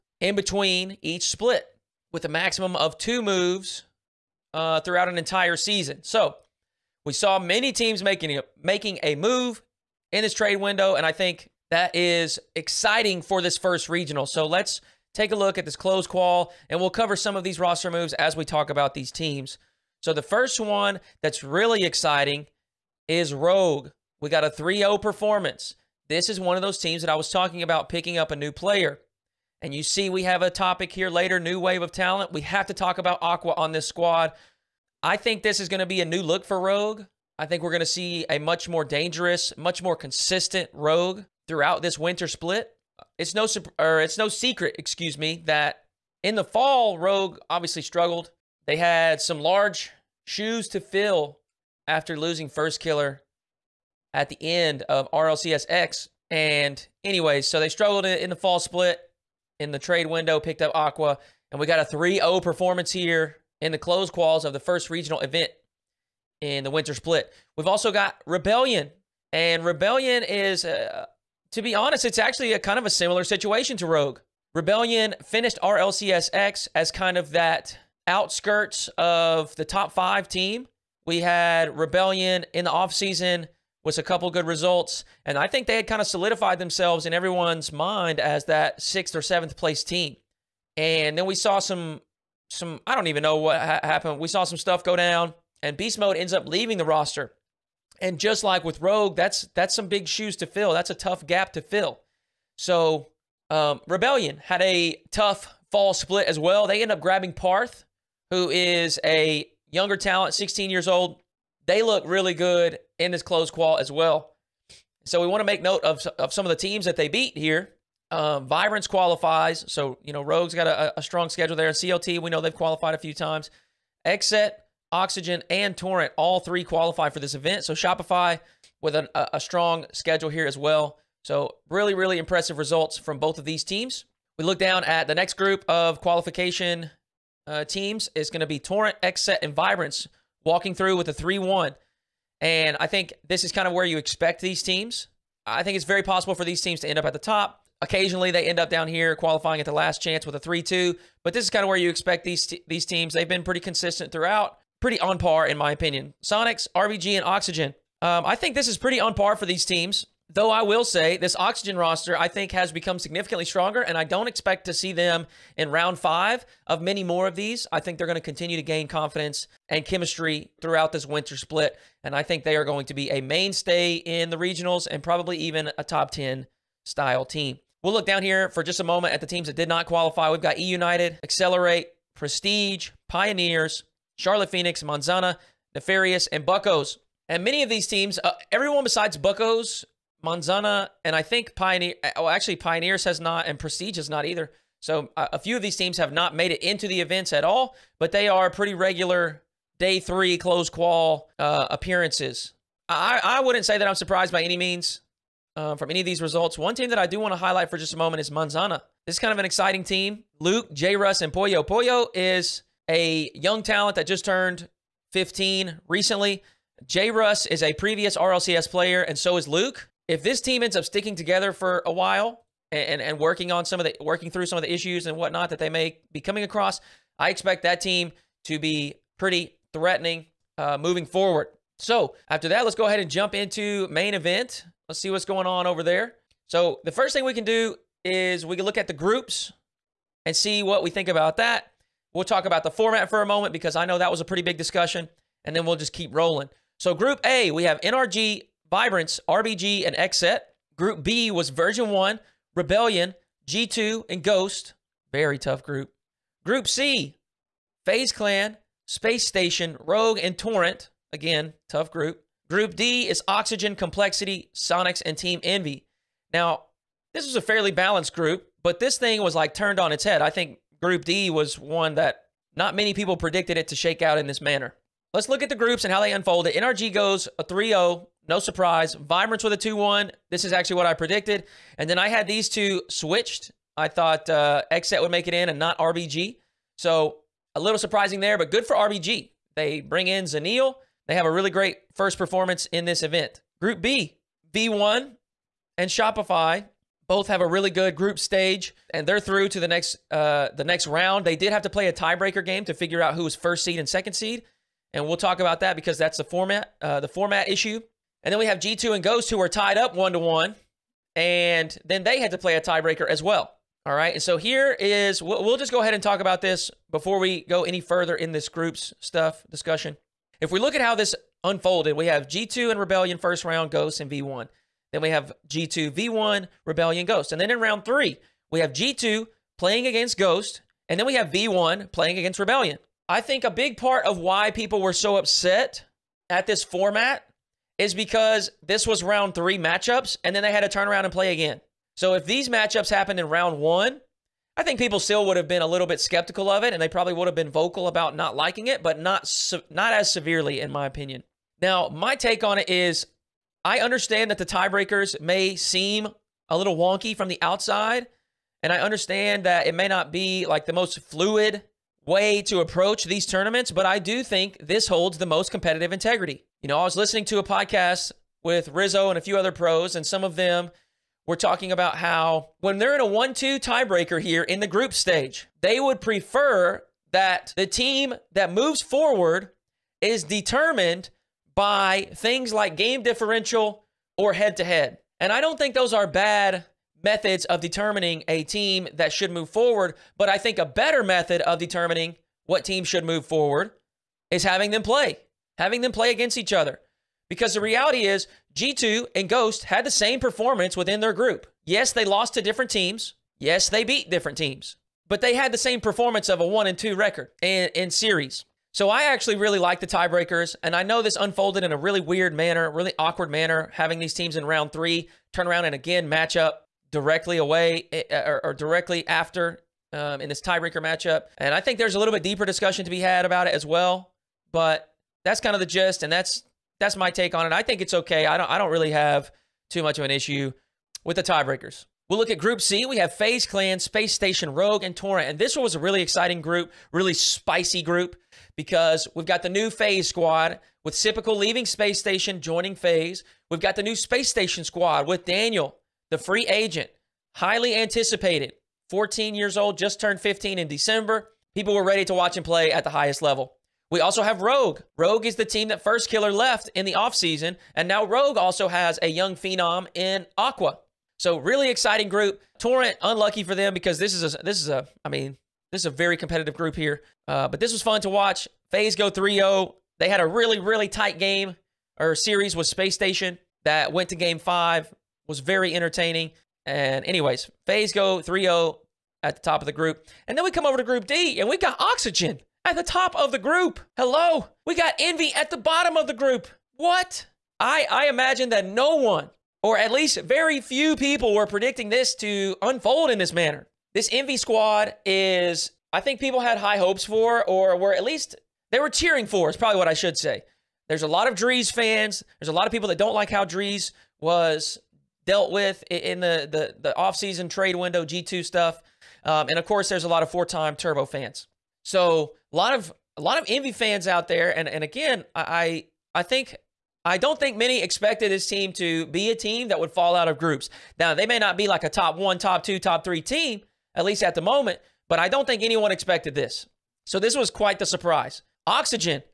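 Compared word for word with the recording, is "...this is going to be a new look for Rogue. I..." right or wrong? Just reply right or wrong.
right.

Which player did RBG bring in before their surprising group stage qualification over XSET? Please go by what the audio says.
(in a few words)
Zanil.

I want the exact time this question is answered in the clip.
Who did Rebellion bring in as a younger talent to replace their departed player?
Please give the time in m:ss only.
1:47.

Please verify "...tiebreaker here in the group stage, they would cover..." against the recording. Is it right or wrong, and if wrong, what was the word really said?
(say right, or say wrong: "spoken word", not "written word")
wrong: "prefer", not "cover".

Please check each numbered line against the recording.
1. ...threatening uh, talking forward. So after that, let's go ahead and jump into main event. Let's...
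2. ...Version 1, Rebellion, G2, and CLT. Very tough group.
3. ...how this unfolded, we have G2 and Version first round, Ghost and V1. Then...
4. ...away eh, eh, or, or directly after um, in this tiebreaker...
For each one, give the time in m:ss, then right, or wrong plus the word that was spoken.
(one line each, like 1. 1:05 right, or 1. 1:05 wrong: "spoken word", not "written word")
1. 3:49 wrong: "moving", not "talking"
2. 4:11 wrong: "Ghost", not "CLT"
3. 5:20 wrong: "Rebellion", not "Version"
4. 6:57 right.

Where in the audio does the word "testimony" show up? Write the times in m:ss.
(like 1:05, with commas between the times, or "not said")
not said.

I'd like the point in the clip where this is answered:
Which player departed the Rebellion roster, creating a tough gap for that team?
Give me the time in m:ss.
1:35.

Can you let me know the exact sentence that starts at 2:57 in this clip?
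We'll look down here for just a moment at the teams that did not qualify.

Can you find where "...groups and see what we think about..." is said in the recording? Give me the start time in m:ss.
3:58.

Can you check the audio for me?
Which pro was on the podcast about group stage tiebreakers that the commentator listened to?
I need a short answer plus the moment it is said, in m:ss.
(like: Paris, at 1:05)
Rizzo, at 6:08.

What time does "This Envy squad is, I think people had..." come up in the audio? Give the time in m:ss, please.
8:13.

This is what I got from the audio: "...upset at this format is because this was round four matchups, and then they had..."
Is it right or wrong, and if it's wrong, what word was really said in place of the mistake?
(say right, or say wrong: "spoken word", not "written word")
wrong: "three", not "four".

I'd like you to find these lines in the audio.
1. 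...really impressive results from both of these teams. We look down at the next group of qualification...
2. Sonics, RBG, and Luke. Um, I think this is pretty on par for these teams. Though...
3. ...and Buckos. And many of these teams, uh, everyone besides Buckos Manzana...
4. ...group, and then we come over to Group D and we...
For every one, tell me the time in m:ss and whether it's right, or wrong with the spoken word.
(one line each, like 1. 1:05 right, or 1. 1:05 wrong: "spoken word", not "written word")
1. 2:11 right
2. 2:36 wrong: "Oxygen", not "Luke"
3. 3:06 right
4. 7:59 right.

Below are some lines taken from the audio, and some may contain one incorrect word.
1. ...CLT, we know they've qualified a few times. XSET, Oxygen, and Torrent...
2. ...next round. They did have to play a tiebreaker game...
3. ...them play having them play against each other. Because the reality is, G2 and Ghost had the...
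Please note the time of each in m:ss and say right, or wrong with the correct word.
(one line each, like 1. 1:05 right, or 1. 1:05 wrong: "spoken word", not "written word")
1. 2:01 right
2. 5:00 right
3. 6:34 right.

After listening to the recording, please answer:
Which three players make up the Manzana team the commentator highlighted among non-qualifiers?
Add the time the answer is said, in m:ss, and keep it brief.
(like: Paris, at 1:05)
Luke, J. Russ, and Poyo, at 3:30.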